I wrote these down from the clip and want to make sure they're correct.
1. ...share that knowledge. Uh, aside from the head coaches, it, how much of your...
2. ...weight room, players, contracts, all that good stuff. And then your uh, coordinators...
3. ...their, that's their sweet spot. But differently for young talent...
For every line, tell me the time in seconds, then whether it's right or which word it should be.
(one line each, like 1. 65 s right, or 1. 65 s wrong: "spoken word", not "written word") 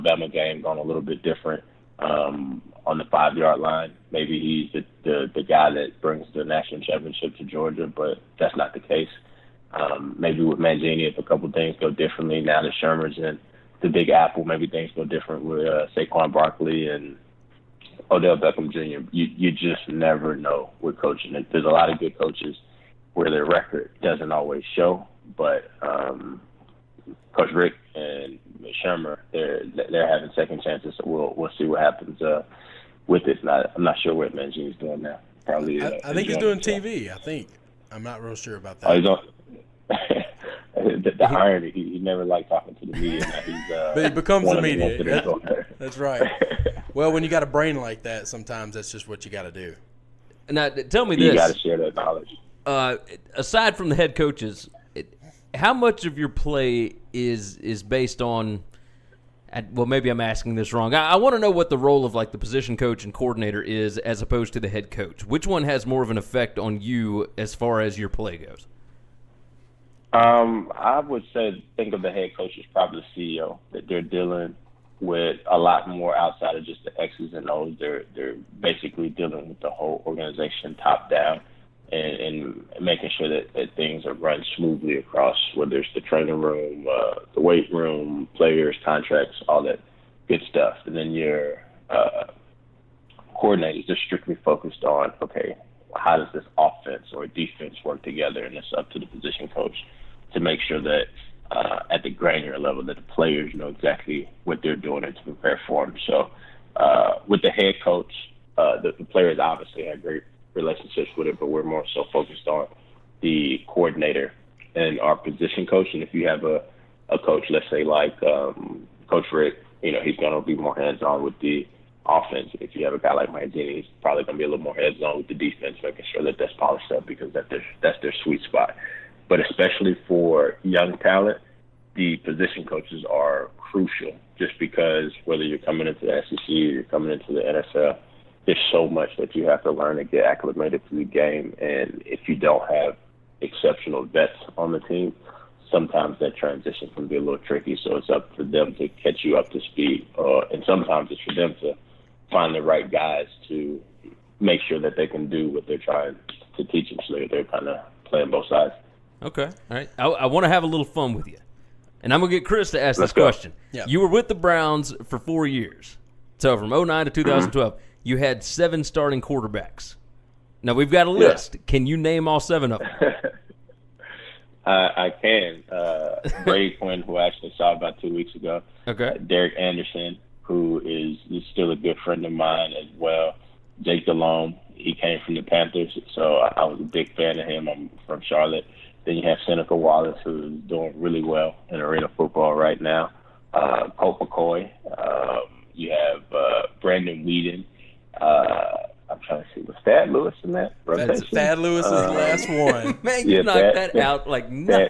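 1. 51 s right
2. 87 s right
3. 127 s wrong: "especially", not "differently".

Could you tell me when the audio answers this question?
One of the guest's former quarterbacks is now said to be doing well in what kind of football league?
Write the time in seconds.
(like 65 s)
191 s.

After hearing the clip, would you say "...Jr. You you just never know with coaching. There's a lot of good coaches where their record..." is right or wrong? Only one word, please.
right.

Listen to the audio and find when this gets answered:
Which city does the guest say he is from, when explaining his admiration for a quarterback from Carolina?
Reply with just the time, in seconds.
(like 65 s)
188 s.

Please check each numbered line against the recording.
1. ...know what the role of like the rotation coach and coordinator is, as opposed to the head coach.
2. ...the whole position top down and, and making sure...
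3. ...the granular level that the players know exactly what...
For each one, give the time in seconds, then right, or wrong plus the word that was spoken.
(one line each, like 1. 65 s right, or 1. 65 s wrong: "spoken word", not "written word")
1. 61 s wrong: "position", not "rotation"
2. 79 s wrong: "organization", not "position"
3. 102 s right.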